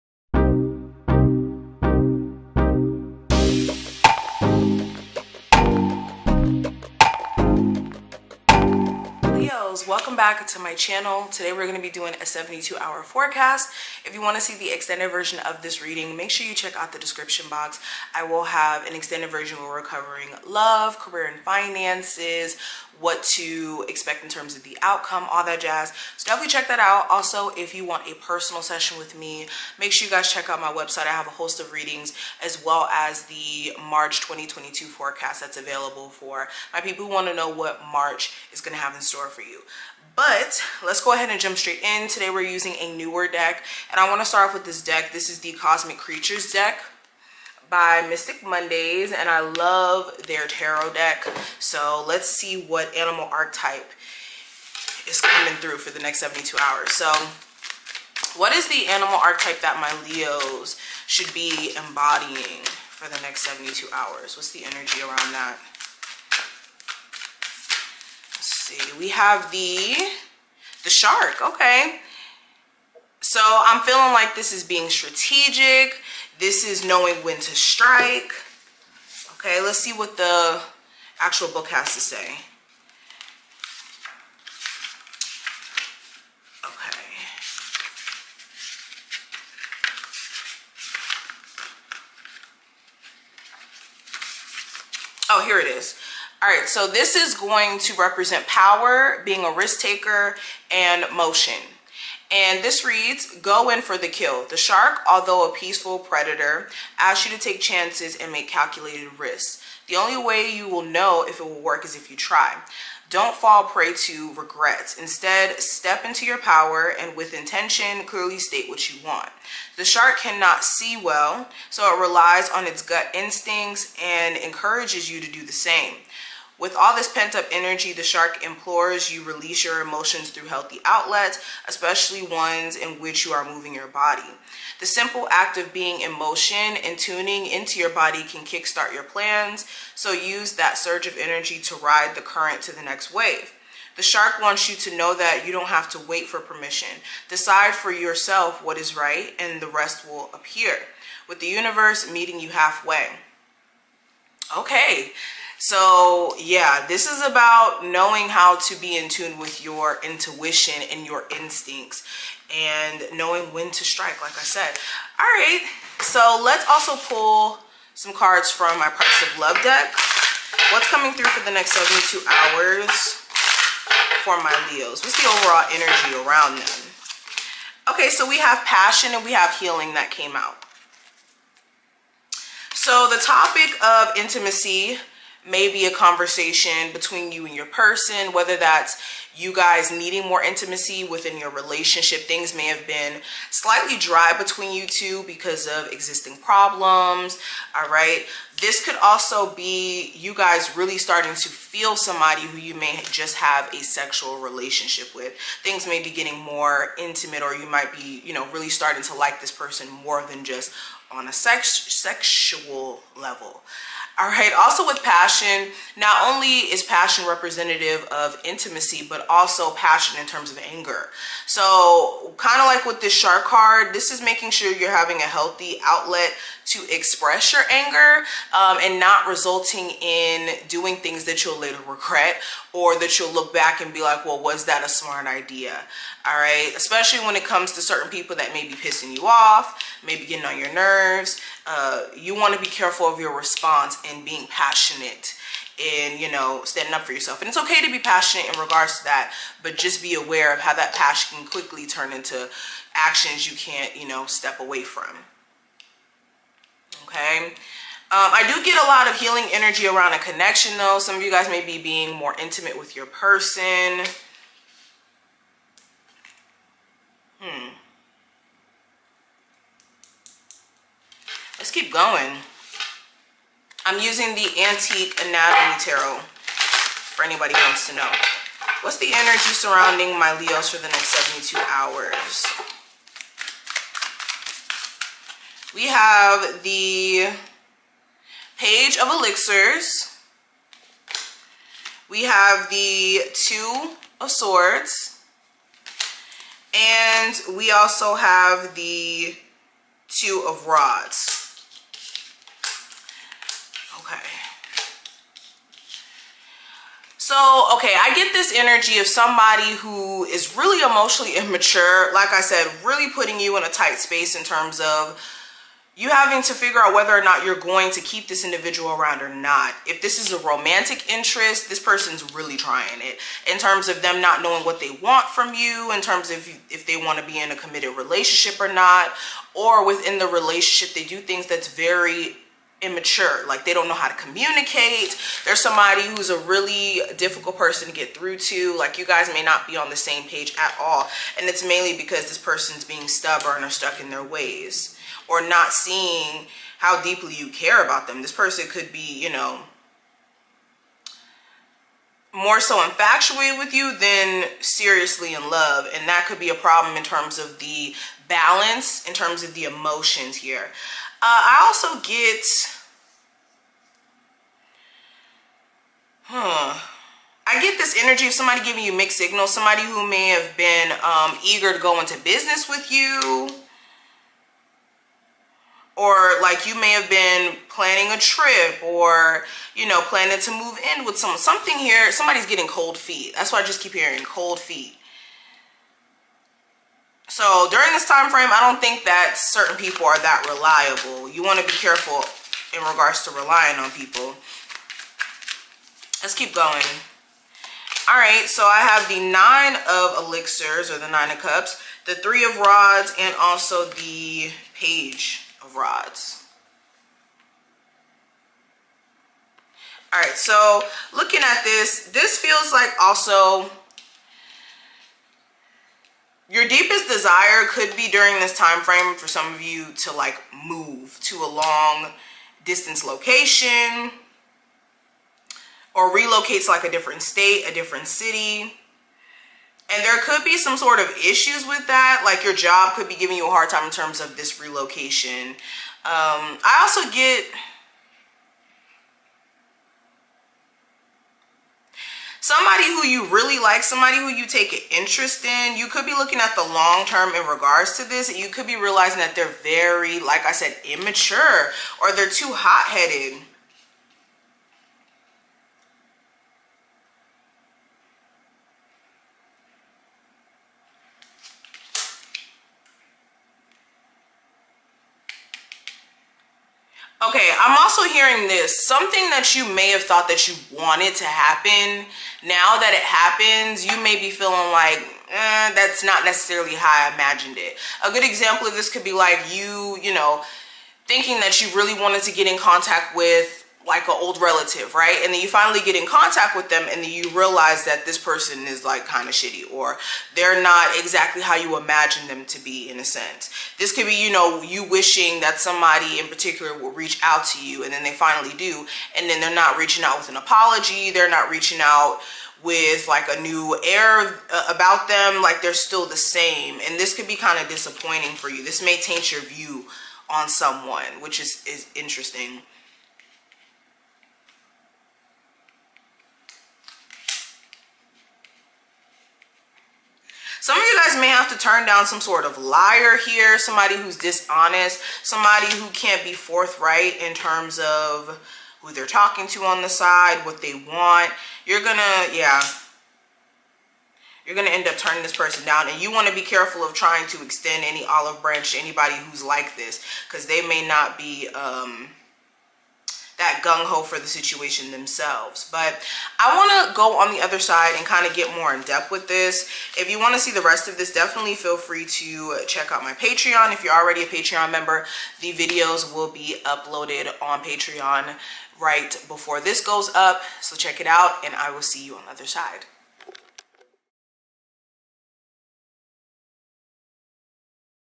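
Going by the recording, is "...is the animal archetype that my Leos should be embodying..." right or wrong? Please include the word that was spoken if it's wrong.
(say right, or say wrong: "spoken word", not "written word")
right.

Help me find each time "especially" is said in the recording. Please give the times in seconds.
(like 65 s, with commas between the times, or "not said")
131 s, 236 s.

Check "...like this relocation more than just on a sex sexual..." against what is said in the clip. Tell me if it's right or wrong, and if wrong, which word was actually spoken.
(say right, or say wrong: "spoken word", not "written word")
wrong: "person", not "relocation".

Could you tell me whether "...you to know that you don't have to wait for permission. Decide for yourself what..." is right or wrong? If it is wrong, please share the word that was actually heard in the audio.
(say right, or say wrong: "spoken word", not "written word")
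right.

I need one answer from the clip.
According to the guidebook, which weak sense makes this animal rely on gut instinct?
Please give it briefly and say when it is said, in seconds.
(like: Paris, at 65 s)
Seeing, at 120 s.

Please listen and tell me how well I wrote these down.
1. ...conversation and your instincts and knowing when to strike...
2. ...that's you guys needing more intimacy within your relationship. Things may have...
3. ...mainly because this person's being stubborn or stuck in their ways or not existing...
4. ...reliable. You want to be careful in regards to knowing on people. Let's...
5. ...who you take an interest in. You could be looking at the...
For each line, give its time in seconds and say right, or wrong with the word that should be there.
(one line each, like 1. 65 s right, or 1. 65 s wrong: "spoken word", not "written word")
1. 160 s wrong: "intuition", not "conversation"
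2. 188 s right
3. 341 s wrong: "seeing", not "existing"
4. 390 s wrong: "relying", not "knowing"
5. 444 s right.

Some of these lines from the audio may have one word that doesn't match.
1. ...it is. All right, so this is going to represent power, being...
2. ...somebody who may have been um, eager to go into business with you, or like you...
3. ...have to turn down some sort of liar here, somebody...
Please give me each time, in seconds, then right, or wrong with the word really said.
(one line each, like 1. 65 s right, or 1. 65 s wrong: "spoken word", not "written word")
1. 95 s right
2. 369 s right
3. 521 s right.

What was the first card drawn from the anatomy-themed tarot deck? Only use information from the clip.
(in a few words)
Page of Elixirs.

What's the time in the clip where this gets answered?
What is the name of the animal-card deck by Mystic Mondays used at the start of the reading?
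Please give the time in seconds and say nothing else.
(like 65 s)
45 s.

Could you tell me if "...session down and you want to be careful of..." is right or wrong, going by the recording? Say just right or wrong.
wrong.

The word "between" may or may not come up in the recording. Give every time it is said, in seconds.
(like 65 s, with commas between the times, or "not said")
186 s, 194 s.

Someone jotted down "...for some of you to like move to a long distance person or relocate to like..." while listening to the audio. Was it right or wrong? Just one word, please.
wrong.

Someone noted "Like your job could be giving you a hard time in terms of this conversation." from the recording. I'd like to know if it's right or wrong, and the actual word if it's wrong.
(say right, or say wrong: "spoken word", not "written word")
wrong: "relocation", not "conversation".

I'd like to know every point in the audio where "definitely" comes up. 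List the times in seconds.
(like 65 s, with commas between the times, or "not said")
26 s, 551 s.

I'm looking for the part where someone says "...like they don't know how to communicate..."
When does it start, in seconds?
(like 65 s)
333 s.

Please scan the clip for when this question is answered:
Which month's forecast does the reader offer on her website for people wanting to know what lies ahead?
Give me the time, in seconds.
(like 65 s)
33 s.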